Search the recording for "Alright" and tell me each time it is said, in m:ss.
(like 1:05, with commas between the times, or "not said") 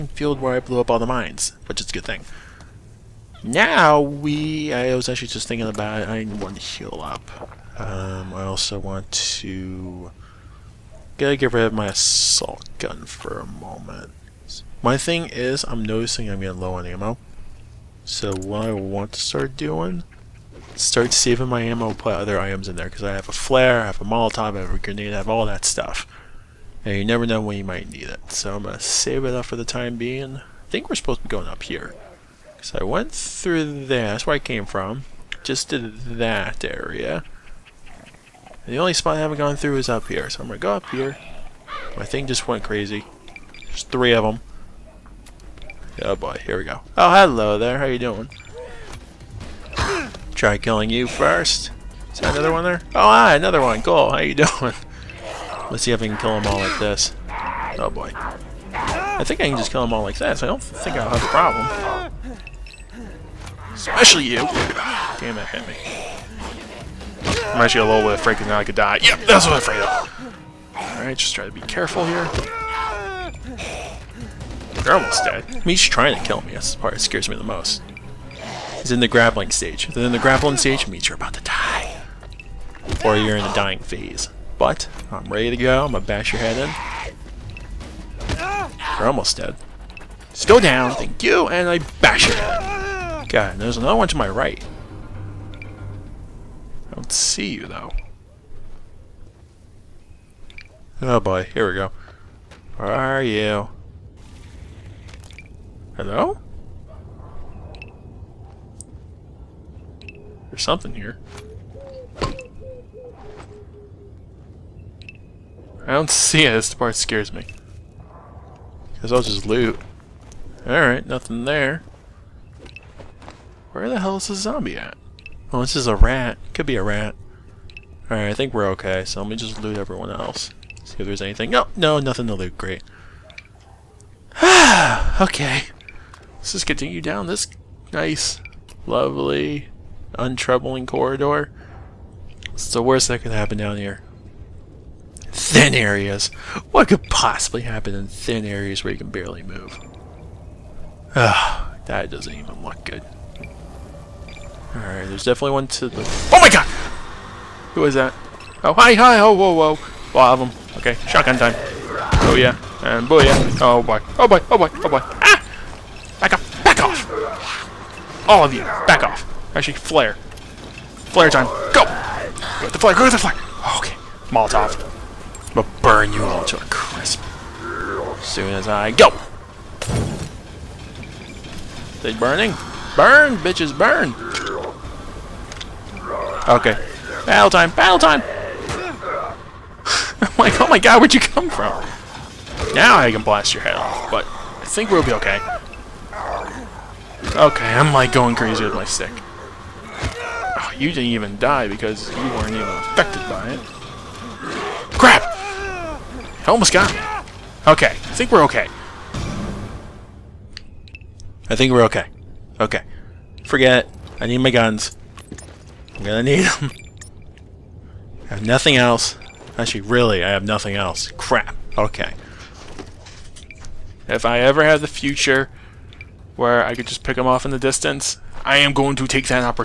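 1:10, 2:00, 2:08, 2:34.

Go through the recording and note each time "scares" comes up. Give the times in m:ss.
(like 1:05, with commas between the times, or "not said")
1:16, 1:56.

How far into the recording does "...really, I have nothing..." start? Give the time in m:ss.
3:39.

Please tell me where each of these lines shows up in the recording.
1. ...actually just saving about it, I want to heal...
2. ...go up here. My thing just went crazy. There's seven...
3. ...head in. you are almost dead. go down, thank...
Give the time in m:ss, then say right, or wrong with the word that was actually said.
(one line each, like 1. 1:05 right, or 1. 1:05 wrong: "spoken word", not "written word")
1. 0:05 wrong: "thinking", not "saving"
2. 0:40 wrong: "three", not "seven"
3. 1:26 right.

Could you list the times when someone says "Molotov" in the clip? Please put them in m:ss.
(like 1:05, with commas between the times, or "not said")
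0:24, 2:54.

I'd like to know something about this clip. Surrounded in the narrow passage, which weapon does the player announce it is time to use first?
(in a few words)
Shotgun.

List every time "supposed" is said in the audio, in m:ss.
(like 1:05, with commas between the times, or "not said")
0:30.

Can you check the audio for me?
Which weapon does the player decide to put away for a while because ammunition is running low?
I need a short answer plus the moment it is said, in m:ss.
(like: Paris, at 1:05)
Assault gun, at 0:11.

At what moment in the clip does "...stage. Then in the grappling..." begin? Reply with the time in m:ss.
1:19.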